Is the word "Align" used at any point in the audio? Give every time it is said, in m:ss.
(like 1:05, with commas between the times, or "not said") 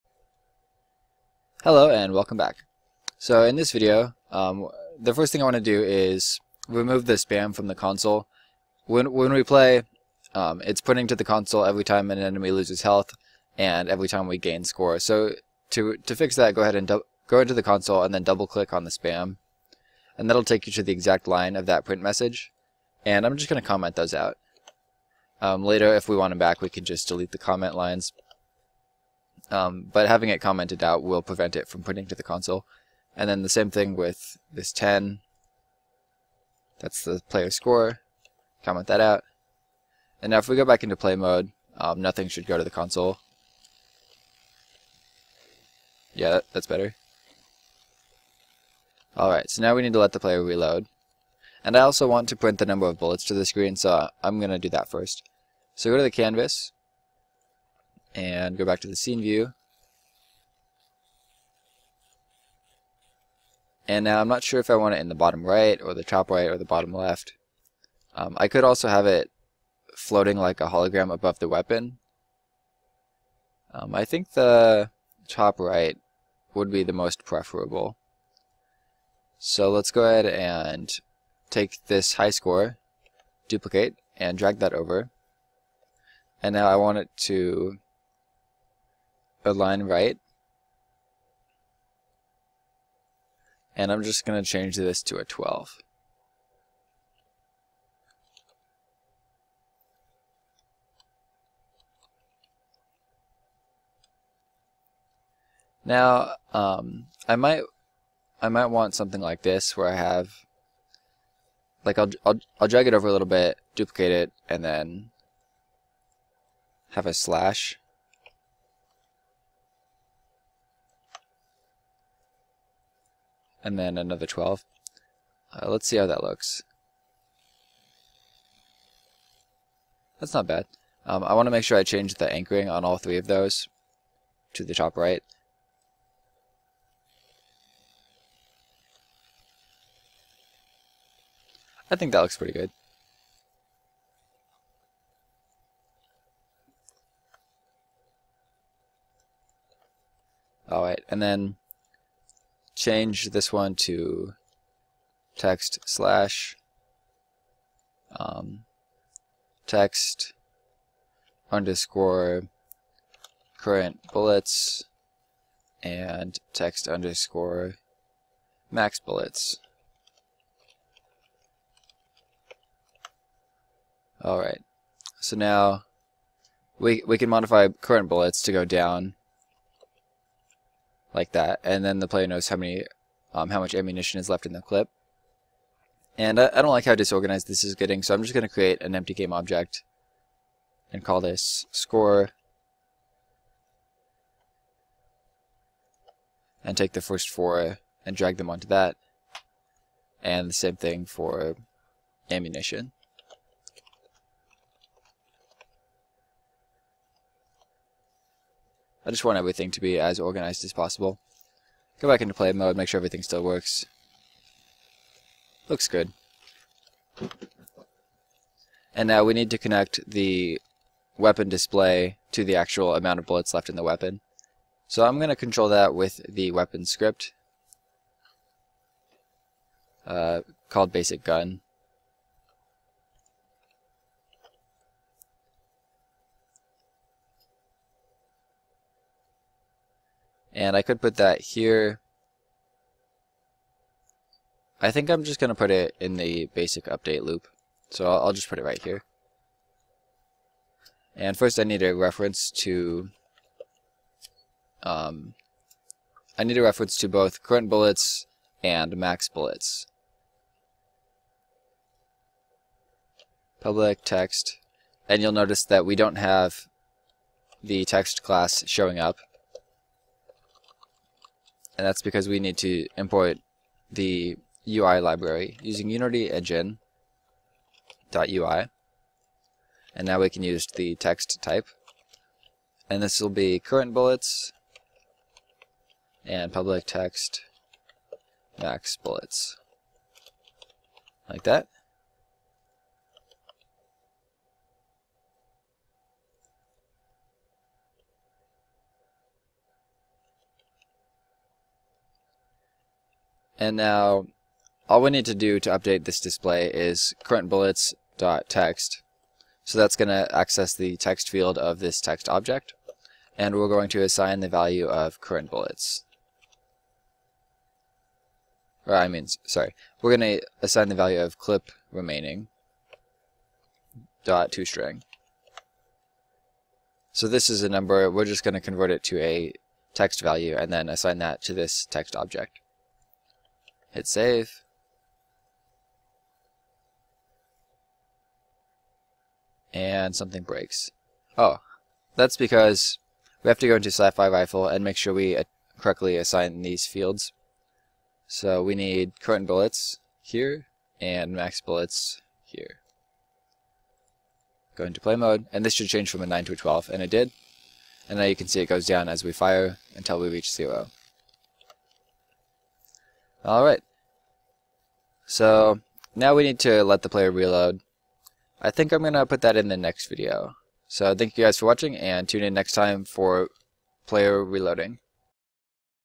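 1:29.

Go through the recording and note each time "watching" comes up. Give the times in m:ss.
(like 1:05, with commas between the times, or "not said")
6:11.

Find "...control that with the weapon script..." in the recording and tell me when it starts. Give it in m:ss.
3:45.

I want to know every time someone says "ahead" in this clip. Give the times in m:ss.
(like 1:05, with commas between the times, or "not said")
0:16, 1:20.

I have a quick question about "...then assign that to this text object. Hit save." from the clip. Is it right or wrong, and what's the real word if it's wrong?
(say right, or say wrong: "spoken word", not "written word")
right.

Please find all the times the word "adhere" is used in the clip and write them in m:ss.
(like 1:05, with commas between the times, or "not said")
not said.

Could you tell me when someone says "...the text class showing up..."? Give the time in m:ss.
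4:27.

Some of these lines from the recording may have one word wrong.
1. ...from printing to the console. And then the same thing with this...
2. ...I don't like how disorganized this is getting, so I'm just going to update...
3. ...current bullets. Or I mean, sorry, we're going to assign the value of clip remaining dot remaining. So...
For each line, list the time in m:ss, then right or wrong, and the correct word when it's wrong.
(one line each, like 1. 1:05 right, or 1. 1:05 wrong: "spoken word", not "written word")
1. 0:31 right
2. 3:06 wrong: "create", not "update"
3. 5:15 wrong: "string", not "remaining".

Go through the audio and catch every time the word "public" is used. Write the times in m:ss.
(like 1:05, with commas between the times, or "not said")
4:23, 4:46.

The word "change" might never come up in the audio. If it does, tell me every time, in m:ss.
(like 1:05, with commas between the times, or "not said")
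1:34, 2:11, 2:32, 5:55.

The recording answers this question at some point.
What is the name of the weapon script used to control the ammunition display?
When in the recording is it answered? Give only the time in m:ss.
3:50.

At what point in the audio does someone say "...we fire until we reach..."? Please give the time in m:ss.
5:59.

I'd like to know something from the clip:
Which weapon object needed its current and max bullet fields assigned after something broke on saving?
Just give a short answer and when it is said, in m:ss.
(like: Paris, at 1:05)
sci-fi rifle, at 5:43.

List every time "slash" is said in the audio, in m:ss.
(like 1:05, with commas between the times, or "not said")
1:57, 2:35.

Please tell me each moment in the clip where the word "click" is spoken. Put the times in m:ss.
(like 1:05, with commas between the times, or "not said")
0:18.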